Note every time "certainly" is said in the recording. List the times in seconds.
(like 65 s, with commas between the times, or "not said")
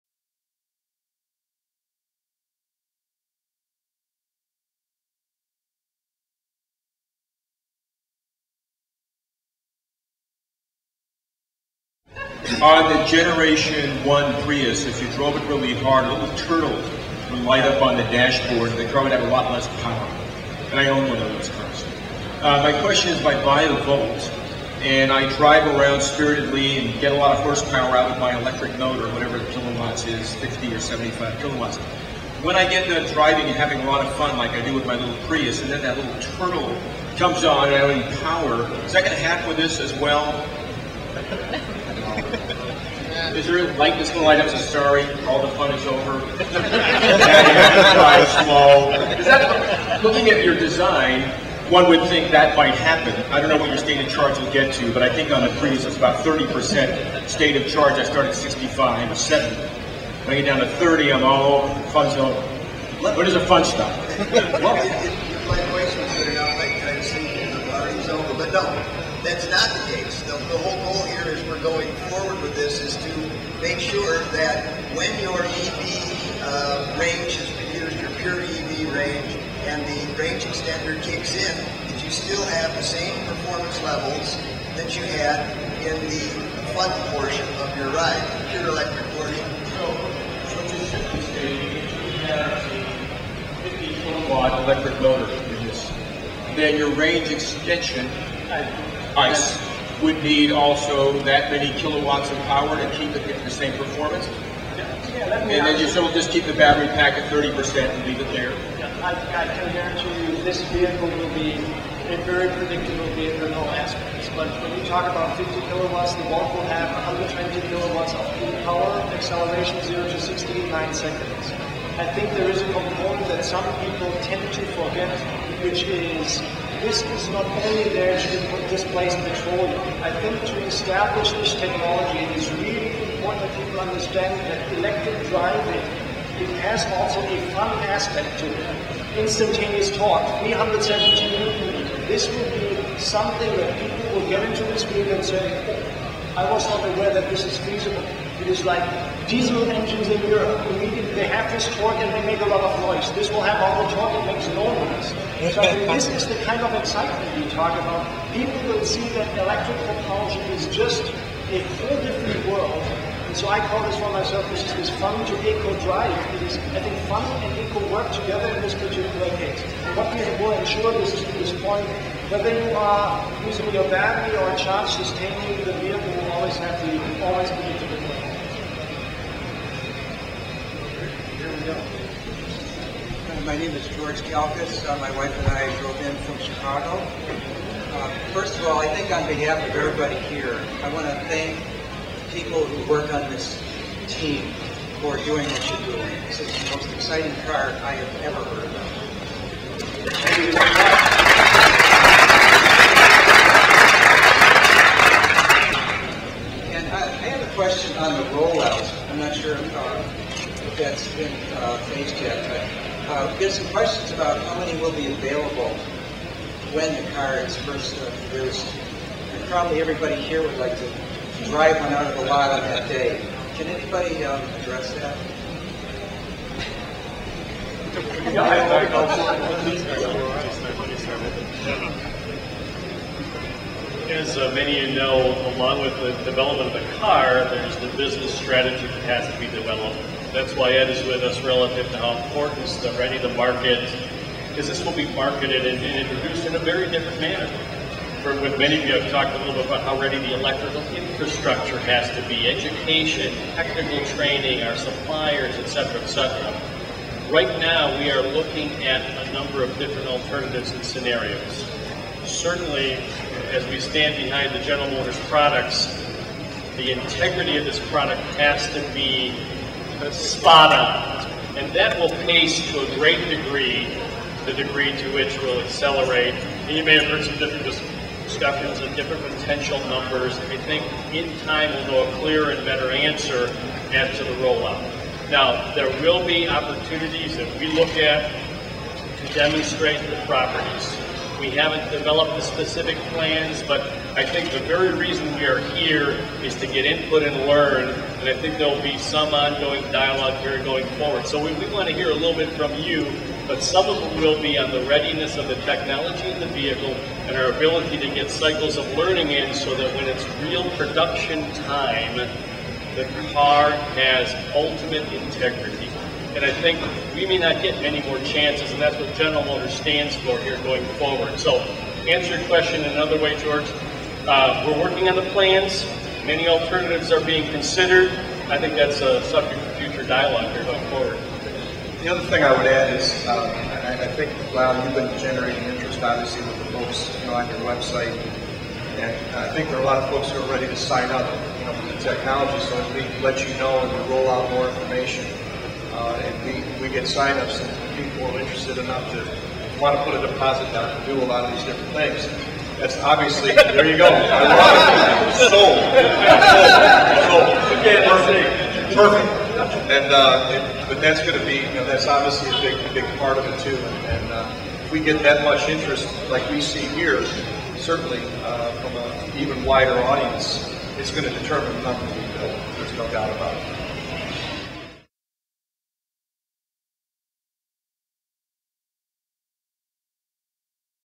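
262 s, 367 s.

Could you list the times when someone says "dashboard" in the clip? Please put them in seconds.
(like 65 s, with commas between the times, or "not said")
18 s.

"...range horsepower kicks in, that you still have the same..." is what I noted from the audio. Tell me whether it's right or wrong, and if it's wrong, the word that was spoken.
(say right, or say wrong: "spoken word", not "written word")
wrong: "extender", not "horsepower".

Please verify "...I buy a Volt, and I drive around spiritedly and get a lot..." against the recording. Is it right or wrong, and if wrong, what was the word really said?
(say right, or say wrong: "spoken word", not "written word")
right.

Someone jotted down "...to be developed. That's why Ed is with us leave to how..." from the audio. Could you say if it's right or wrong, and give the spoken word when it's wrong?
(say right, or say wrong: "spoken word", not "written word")
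wrong: "relative", not "leave".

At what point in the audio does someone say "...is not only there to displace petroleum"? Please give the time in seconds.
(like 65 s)
127 s.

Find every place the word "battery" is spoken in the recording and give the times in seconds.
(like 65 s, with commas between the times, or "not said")
106 s, 173 s.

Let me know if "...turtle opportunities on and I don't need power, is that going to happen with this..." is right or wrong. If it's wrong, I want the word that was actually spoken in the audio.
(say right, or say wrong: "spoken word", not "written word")
wrong: "comes", not "opportunities".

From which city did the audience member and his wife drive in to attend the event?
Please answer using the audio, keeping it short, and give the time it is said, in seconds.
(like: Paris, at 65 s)
Chicago, at 186 s.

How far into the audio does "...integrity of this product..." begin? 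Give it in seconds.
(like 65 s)
266 s.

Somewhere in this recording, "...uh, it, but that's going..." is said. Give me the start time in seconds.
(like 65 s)
360 s.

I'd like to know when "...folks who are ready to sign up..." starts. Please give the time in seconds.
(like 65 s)
340 s.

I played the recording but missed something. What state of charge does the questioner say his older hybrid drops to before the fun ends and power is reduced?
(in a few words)
30%.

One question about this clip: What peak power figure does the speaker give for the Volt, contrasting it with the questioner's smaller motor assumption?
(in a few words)
120 kilowatts.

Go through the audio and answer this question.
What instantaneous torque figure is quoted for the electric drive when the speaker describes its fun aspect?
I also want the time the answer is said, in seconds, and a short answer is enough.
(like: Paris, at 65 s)
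317 newton meters, at 140 s.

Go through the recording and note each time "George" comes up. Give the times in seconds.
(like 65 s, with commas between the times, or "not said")
183 s, 323 s.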